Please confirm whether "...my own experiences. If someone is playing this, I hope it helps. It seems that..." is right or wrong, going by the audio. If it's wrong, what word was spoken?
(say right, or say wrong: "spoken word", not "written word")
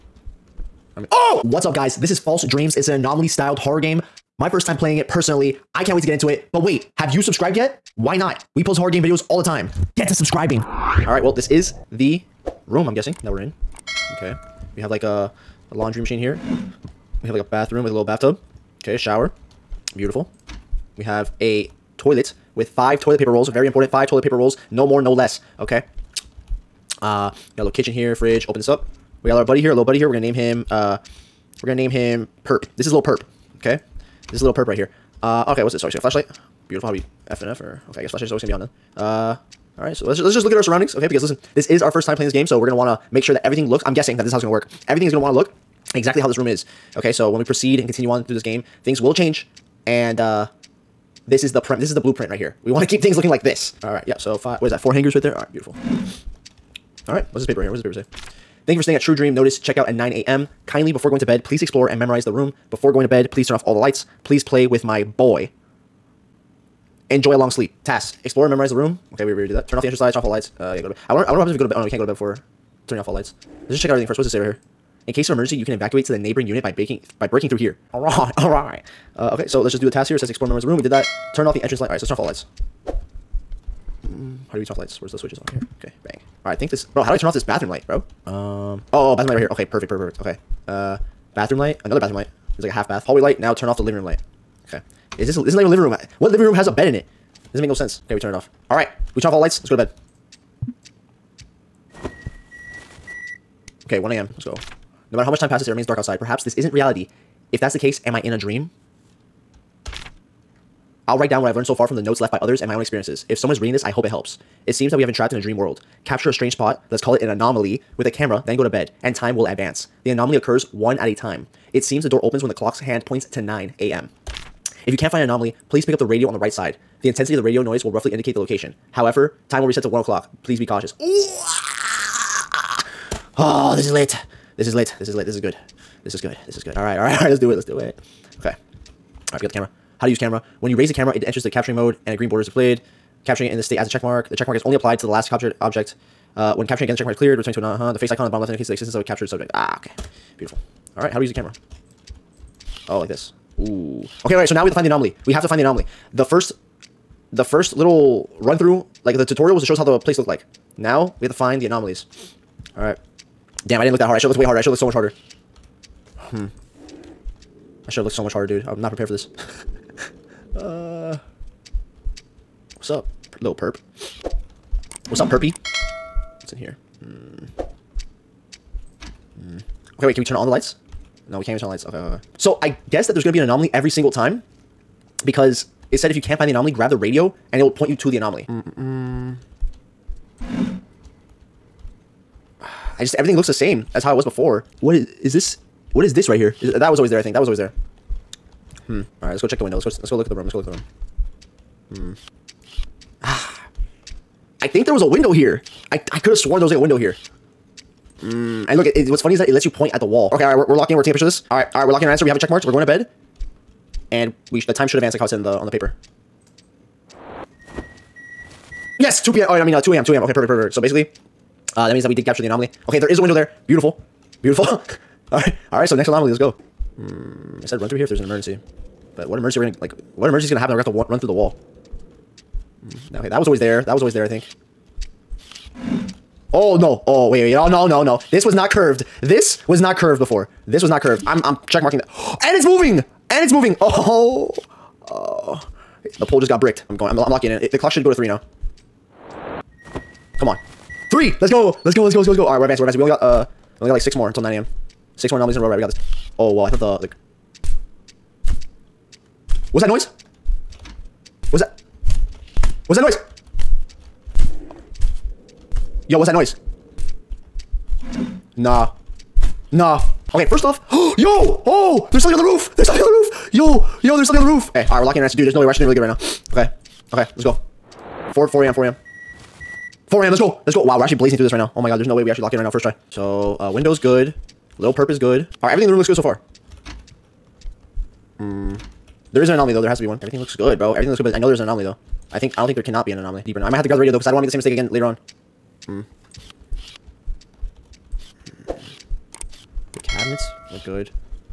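wrong: "reading", not "playing".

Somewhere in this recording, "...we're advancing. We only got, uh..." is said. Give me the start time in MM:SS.
04:12.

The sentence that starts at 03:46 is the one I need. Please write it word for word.
Mm, I said run through here if there's an emergency.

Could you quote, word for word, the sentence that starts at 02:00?
The anomaly occurs one at a time.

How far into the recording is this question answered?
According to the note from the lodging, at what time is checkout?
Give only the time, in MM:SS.
00:59.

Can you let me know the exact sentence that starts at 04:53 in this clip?
I might have to grab the radio, though, because I don't want to make the same mistake again later on.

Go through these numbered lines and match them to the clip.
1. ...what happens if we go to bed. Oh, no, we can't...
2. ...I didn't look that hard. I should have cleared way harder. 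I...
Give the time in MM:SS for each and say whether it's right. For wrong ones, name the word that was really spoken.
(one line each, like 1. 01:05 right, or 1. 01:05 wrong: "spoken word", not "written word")
1. 01:11 right
2. 02:43 wrong: "looked", not "cleared".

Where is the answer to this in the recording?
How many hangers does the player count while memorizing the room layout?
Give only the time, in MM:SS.
00:54.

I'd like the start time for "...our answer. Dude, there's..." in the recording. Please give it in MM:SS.
04:35.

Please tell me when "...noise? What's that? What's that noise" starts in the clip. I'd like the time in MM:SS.
04:19.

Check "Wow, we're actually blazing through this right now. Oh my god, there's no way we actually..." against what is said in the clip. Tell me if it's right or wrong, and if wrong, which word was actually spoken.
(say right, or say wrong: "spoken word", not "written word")
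right.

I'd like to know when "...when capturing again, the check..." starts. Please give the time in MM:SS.
02:26.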